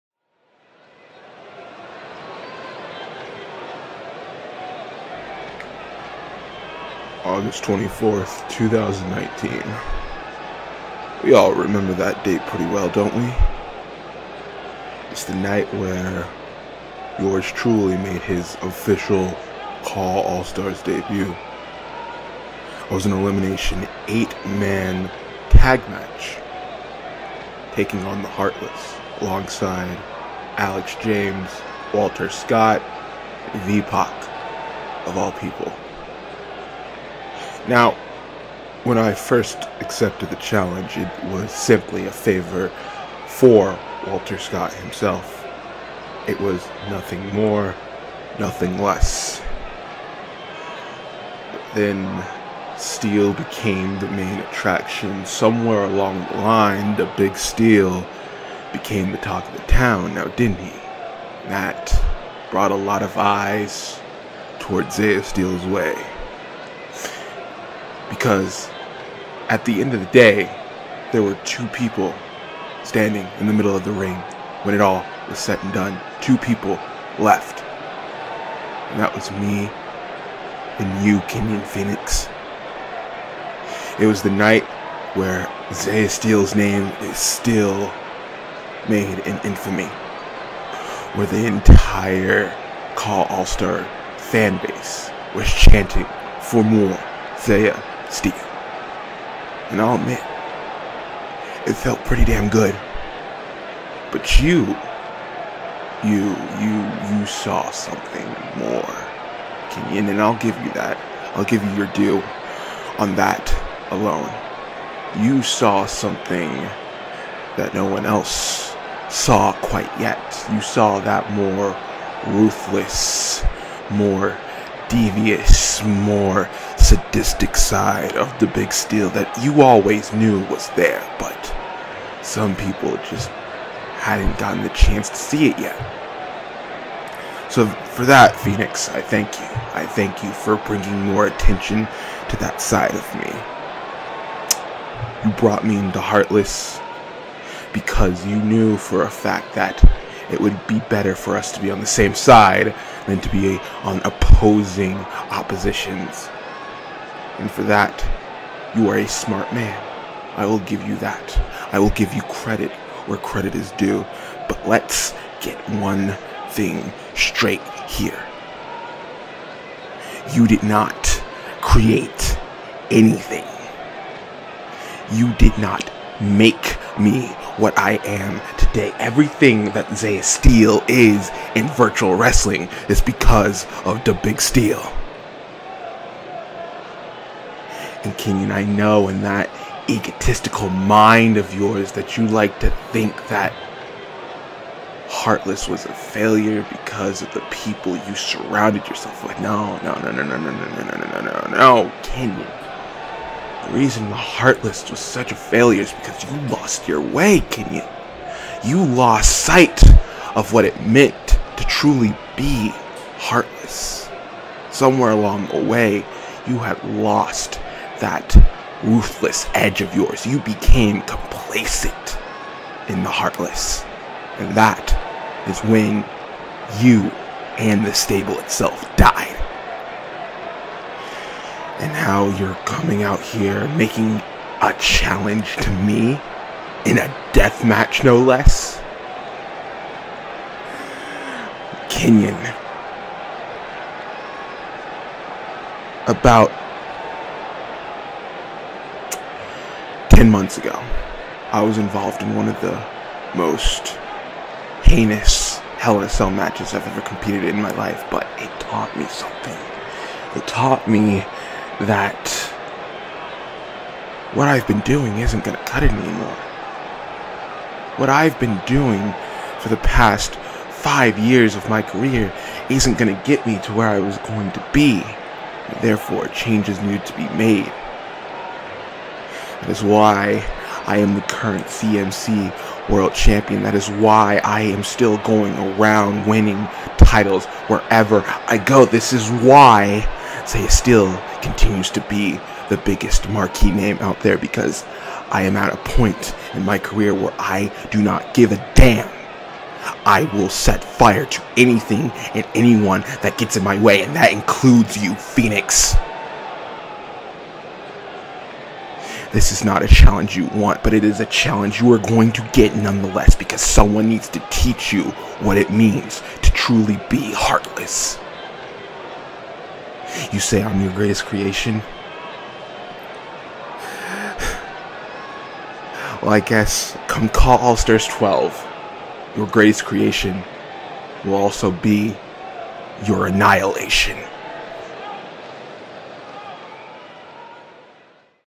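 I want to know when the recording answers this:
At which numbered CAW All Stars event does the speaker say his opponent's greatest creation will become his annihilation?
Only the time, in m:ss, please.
5:27.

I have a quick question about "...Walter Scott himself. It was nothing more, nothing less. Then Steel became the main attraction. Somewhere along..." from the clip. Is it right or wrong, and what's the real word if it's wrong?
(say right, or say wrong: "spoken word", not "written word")
right.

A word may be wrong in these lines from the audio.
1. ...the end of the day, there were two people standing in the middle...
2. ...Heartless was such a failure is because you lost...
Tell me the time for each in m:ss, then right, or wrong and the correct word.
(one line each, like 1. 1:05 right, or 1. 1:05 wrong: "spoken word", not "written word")
1. 1:09 right
2. 3:24 right.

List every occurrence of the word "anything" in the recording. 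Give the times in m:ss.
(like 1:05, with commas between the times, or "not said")
2:52, 5:01.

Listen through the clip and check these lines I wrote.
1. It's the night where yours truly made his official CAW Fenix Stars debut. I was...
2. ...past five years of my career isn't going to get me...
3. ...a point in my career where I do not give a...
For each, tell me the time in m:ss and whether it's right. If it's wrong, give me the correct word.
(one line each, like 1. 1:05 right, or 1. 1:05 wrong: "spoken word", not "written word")
1. 0:15 wrong: "All", not "Fenix"
2. 4:29 right
3. 4:55 right.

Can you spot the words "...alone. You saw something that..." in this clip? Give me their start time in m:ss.
1:53.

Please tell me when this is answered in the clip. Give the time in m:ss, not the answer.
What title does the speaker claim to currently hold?
4:41.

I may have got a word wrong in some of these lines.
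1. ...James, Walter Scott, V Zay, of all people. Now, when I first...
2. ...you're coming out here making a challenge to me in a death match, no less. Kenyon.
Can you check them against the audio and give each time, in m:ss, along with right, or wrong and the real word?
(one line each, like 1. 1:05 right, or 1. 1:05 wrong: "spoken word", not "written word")
1. 0:31 wrong: "Pac", not "Zay"
2. 3:52 right.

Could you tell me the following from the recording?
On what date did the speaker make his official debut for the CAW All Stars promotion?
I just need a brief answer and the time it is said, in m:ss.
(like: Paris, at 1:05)
August 24th, 2019, at 0:07.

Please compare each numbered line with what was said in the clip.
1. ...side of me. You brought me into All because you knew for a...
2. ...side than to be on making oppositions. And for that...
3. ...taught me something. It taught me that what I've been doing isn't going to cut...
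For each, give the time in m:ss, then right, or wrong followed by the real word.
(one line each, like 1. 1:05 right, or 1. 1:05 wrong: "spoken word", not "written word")
1. 2:22 wrong: "Heartless", not "All"
2. 2:32 wrong: "opposing", not "making"
3. 4:18 right.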